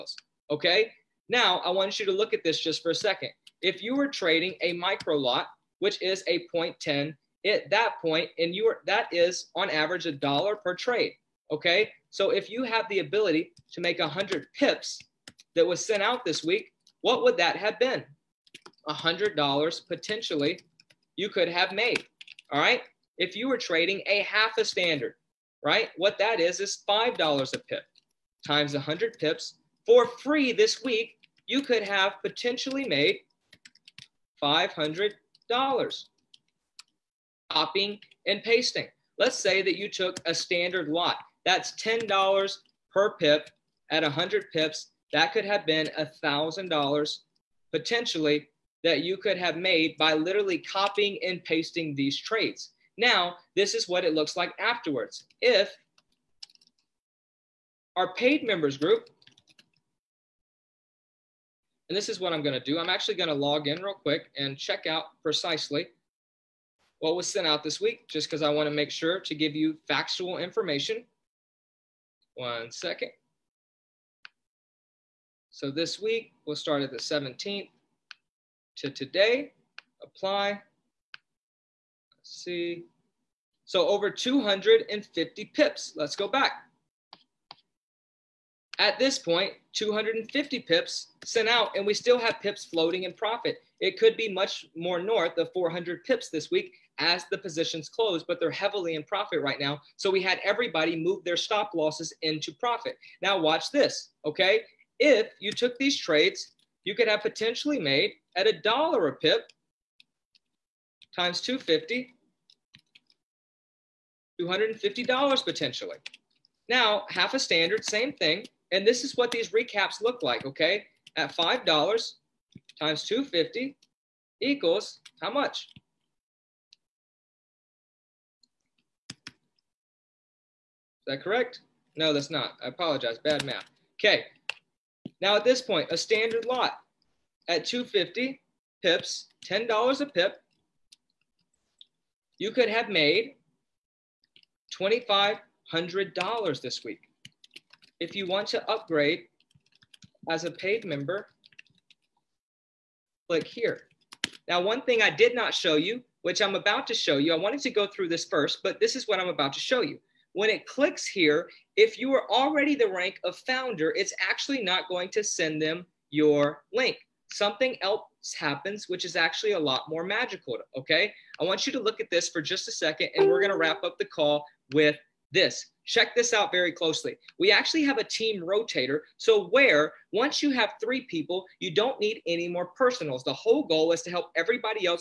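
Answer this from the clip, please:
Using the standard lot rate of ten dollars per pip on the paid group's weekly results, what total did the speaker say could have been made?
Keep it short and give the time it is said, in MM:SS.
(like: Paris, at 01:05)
$2,500, at 02:24.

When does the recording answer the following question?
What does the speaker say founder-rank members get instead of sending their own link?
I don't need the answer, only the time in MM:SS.
02:58.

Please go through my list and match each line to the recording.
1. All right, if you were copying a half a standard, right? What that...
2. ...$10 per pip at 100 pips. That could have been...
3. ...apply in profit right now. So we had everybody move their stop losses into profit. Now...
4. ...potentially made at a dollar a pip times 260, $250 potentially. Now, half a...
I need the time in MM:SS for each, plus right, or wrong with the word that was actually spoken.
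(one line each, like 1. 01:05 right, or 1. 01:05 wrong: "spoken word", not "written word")
1. 00:22 wrong: "trading", not "copying"
2. 00:41 right
3. 01:38 wrong: "heavily", not "apply"
4. 01:47 wrong: "250", not "260".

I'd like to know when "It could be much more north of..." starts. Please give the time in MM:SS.
01:33.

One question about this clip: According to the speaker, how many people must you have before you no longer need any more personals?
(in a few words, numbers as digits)
3.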